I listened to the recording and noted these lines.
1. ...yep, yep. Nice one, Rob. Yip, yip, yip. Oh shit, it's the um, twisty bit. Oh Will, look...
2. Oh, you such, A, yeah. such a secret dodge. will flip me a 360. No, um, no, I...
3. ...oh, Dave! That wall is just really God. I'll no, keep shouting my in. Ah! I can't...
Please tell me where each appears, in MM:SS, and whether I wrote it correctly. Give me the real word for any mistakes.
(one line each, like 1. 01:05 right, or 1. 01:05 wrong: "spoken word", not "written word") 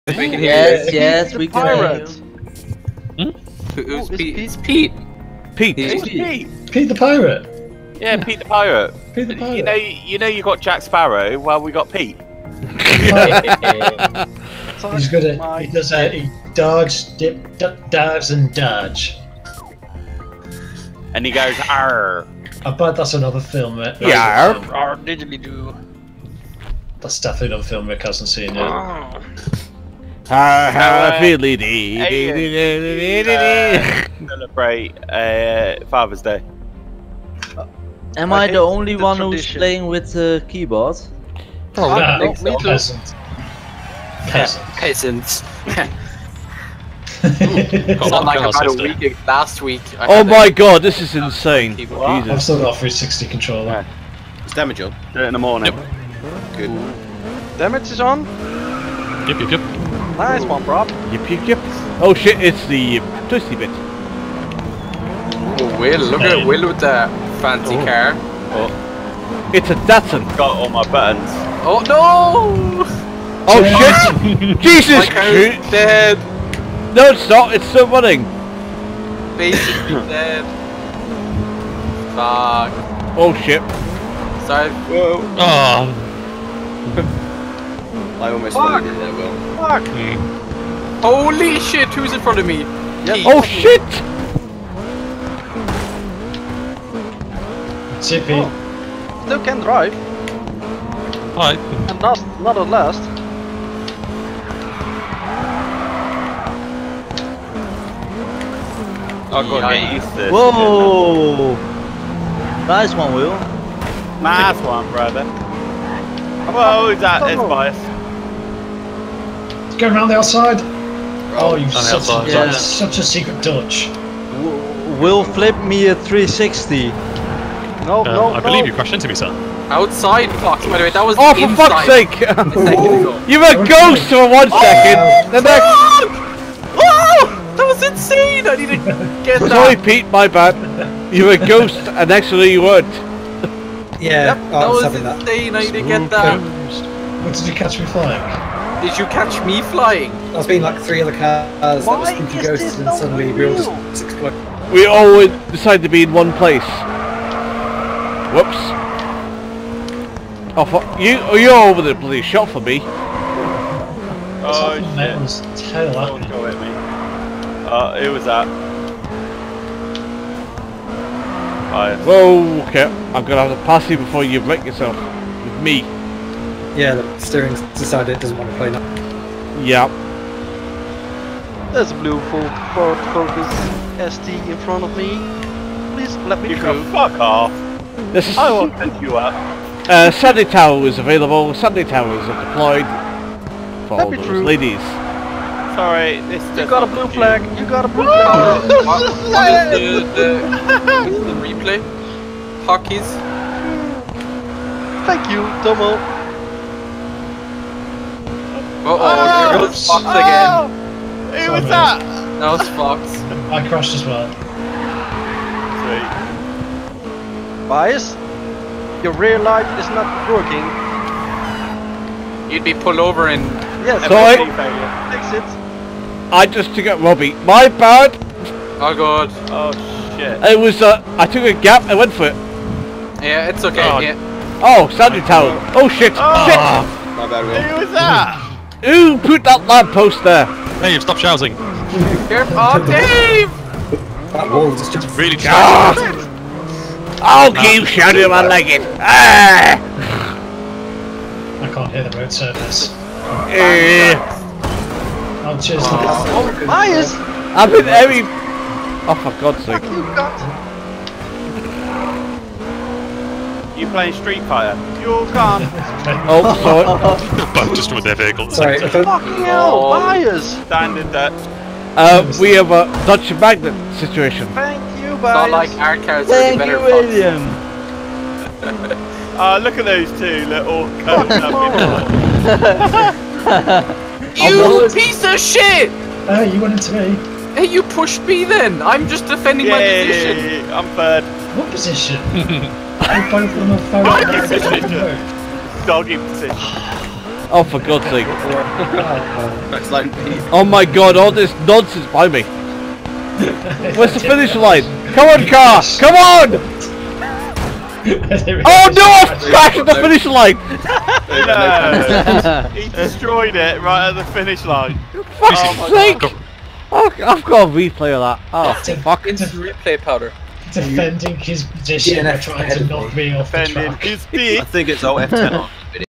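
1. 00:59 right
2. 02:01 right
3. 04:02 right.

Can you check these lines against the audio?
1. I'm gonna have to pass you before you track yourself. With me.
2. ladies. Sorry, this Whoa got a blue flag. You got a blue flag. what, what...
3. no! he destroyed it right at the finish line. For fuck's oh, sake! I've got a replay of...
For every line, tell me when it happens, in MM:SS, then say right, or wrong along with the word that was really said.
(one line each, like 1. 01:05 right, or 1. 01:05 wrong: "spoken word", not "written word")
1. 02:53 wrong: "wreck", not "track"
2. 03:14 wrong: "You", not "Whoa"
3. 05:11 right.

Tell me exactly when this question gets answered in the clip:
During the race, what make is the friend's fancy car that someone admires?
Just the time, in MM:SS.
01:09.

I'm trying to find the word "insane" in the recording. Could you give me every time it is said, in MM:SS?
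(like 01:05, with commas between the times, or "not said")
00:51, 02:17, 02:25.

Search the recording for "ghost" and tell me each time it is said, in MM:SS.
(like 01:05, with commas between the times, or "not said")
02:13, 02:21, 02:32.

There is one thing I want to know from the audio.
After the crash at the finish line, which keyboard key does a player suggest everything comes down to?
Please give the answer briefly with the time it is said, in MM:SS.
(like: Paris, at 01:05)
F10, at 05:25.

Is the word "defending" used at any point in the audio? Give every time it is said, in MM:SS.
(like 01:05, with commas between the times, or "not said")
04:49, 05:20.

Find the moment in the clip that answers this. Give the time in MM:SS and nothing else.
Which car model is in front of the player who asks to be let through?
03:02.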